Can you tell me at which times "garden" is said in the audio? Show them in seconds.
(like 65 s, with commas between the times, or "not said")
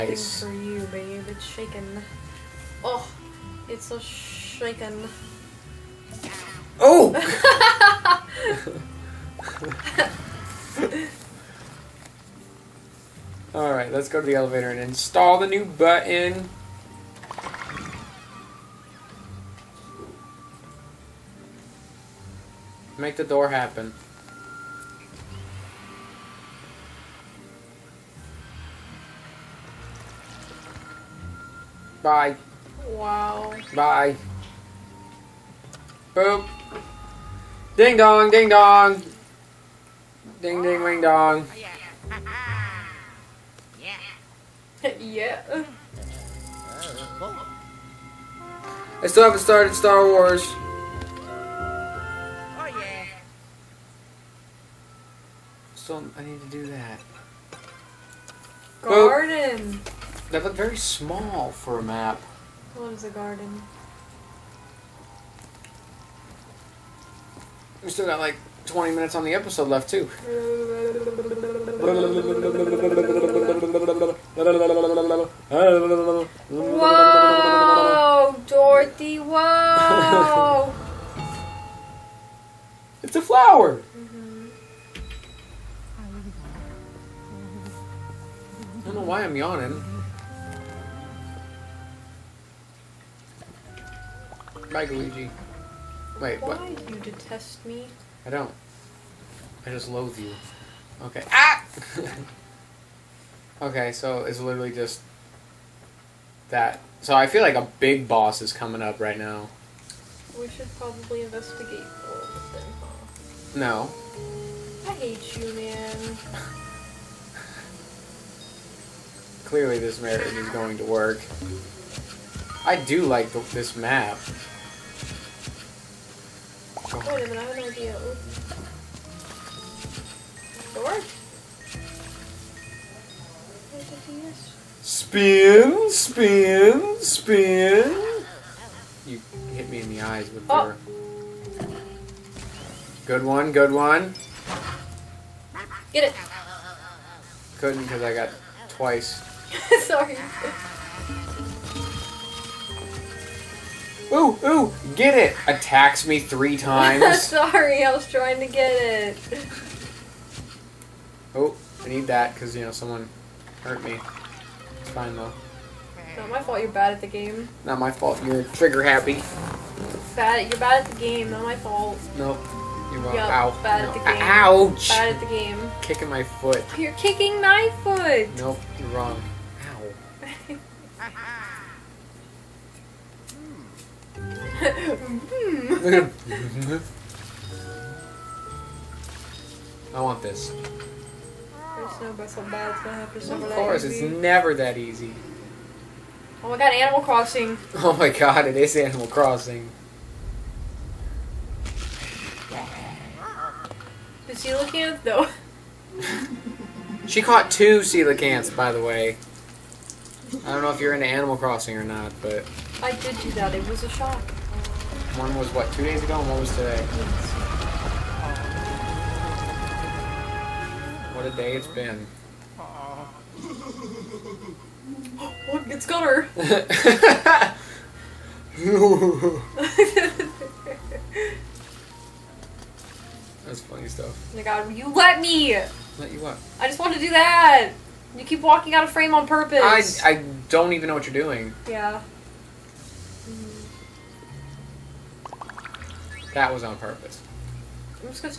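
58 s, 63 s.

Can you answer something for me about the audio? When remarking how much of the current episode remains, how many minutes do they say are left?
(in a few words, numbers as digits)
20.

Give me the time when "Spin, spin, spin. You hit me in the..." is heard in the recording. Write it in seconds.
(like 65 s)
134 s.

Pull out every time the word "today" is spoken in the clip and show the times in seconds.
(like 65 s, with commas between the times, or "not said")
216 s.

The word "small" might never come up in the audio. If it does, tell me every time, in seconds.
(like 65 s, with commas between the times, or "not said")
60 s.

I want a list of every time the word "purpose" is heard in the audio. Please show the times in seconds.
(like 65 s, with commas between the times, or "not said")
239 s, 246 s.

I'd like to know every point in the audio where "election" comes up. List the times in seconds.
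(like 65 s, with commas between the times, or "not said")
not said.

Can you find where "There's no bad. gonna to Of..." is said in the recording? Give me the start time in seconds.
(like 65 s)
191 s.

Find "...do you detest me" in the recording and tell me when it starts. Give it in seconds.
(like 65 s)
96 s.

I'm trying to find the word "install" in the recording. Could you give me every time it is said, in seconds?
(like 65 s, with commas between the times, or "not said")
14 s.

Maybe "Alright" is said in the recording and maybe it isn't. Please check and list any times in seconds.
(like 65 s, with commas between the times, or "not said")
13 s.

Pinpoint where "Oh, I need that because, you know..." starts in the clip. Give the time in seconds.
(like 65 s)
161 s.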